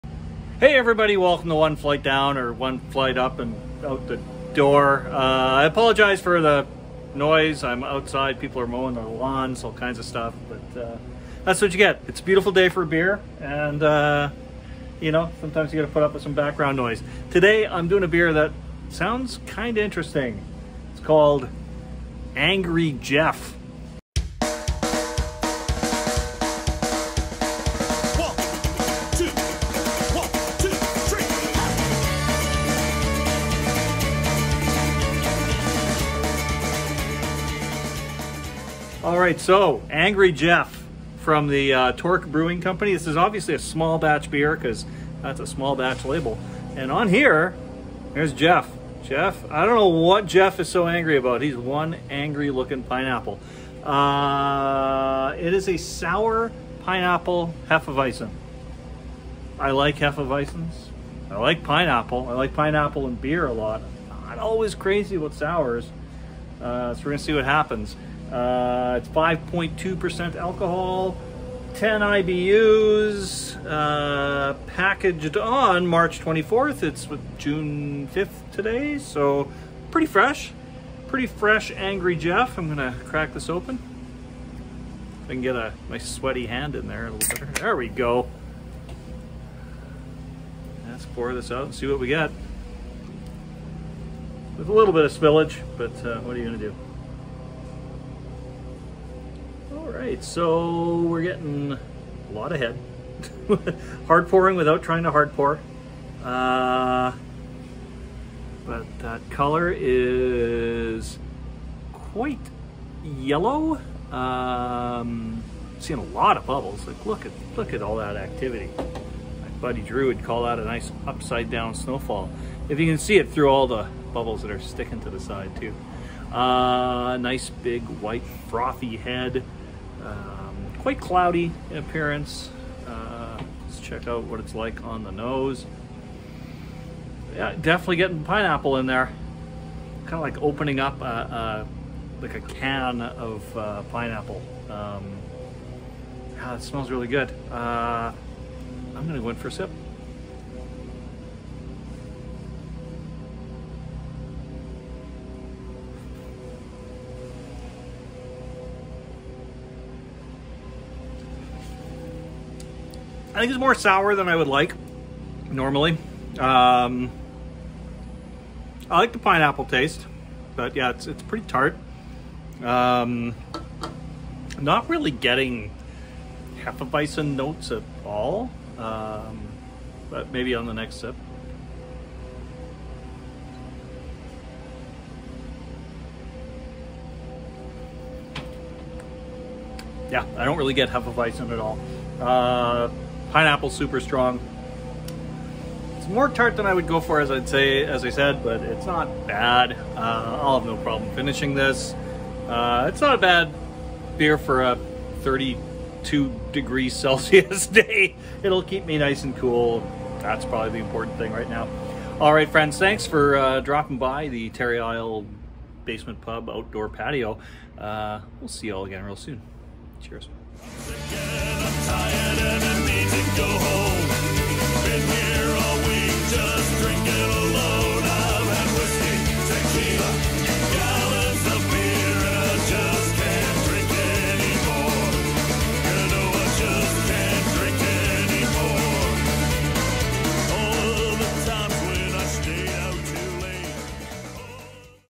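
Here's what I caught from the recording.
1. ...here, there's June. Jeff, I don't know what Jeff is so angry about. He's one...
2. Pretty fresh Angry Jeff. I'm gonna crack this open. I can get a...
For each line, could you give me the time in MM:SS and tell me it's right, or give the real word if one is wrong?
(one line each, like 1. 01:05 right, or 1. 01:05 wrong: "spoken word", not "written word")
1. 00:47 wrong: "Jeff", not "June"
2. 01:21 right.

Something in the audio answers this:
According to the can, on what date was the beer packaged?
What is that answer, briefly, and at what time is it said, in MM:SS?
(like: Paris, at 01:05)
March 24th, at 01:15.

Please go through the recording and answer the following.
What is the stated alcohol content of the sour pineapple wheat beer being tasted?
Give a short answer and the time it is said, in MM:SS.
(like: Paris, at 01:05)
5.2%, at 01:09.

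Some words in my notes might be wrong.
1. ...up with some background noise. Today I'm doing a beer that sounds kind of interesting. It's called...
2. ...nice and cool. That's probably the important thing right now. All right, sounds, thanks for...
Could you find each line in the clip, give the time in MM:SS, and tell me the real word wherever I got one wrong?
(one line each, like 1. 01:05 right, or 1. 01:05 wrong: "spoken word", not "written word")
1. 00:16 right
2. 03:28 wrong: "friends", not "sounds".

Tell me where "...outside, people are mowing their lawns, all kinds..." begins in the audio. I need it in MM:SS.
00:07.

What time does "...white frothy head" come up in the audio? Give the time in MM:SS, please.
02:08.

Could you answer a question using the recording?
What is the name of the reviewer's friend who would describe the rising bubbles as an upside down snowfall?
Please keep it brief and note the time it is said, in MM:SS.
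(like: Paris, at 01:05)
Drew, at 01:59.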